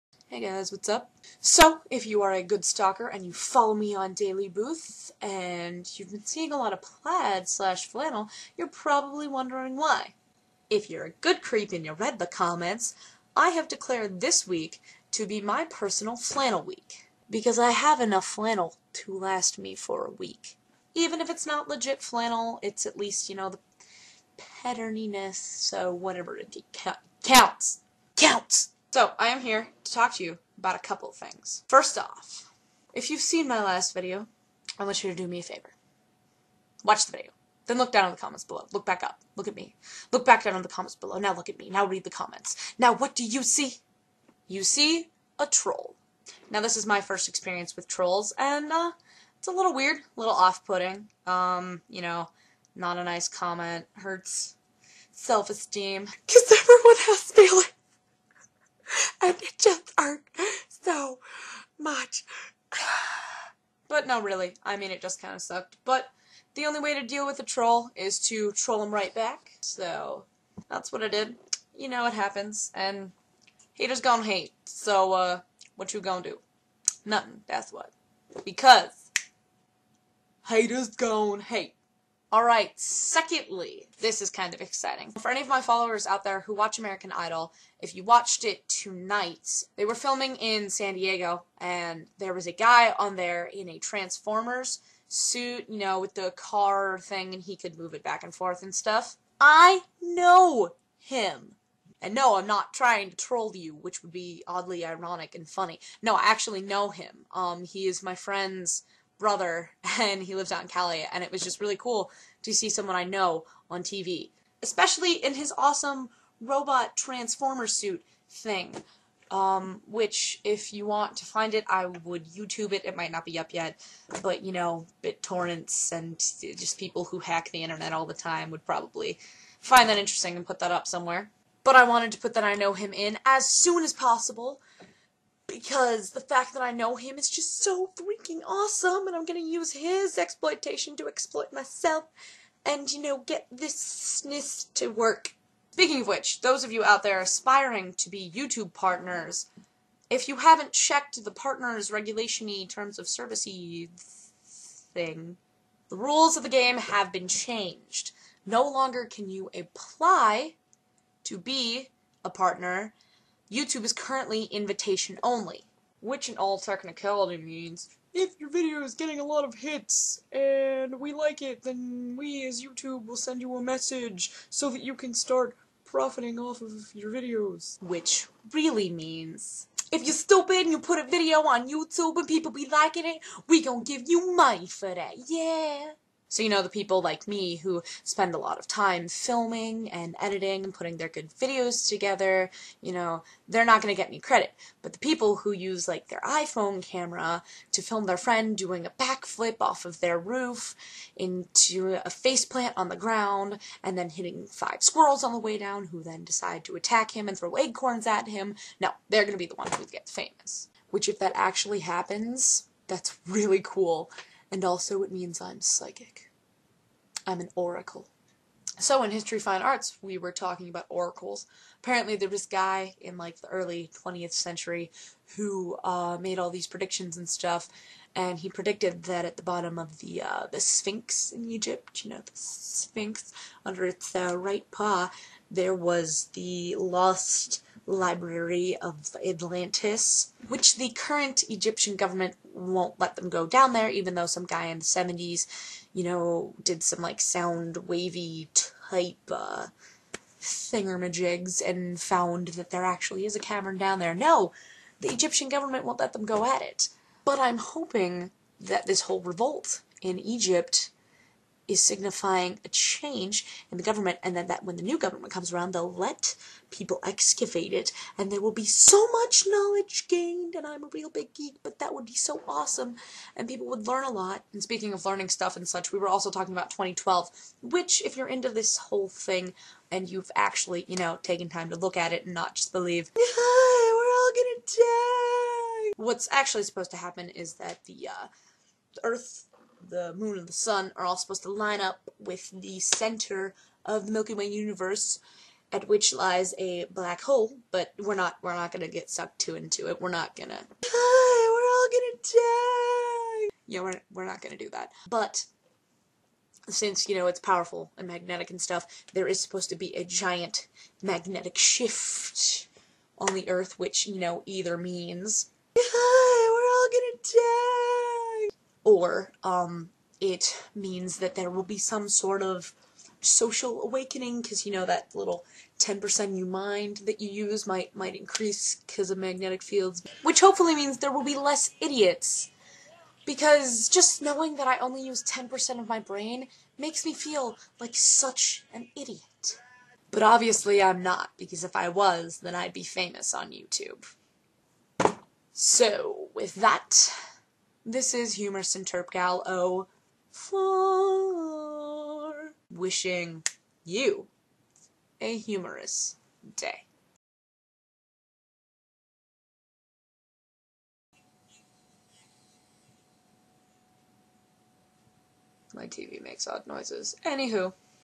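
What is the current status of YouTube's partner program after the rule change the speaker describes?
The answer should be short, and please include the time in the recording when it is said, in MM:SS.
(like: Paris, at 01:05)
invitation only, at 02:44.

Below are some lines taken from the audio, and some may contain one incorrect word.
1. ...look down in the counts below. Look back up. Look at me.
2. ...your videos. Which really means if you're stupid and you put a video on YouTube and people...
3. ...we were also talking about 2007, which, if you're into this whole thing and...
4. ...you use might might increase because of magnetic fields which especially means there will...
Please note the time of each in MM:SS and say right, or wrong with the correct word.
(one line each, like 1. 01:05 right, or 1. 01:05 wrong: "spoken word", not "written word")
1. 00:37 wrong: "comments", not "counts"
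2. 02:56 right
3. 04:35 wrong: "2012", not "2007"
4. 05:27 wrong: "hopefully", not "especially".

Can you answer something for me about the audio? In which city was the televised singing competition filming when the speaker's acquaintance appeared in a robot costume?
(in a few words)
San Diego.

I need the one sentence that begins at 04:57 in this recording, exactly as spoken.
But we're not we're not gonna get sucked too into it.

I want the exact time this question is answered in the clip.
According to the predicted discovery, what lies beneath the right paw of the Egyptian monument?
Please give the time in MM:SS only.
03:56.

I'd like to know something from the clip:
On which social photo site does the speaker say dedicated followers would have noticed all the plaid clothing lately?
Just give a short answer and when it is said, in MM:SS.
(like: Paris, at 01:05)
DailyBooth, at 00:04.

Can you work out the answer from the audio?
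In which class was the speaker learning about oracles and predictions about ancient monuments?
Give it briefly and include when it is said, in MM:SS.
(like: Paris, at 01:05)
History Fine Arts, at 03:39.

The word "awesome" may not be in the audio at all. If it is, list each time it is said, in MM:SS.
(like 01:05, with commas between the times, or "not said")
01:55, 02:18, 04:32.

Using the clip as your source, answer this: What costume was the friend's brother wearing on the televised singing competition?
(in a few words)
Transformers suit.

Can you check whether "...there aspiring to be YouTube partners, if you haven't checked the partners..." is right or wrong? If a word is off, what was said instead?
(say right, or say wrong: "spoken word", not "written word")
right.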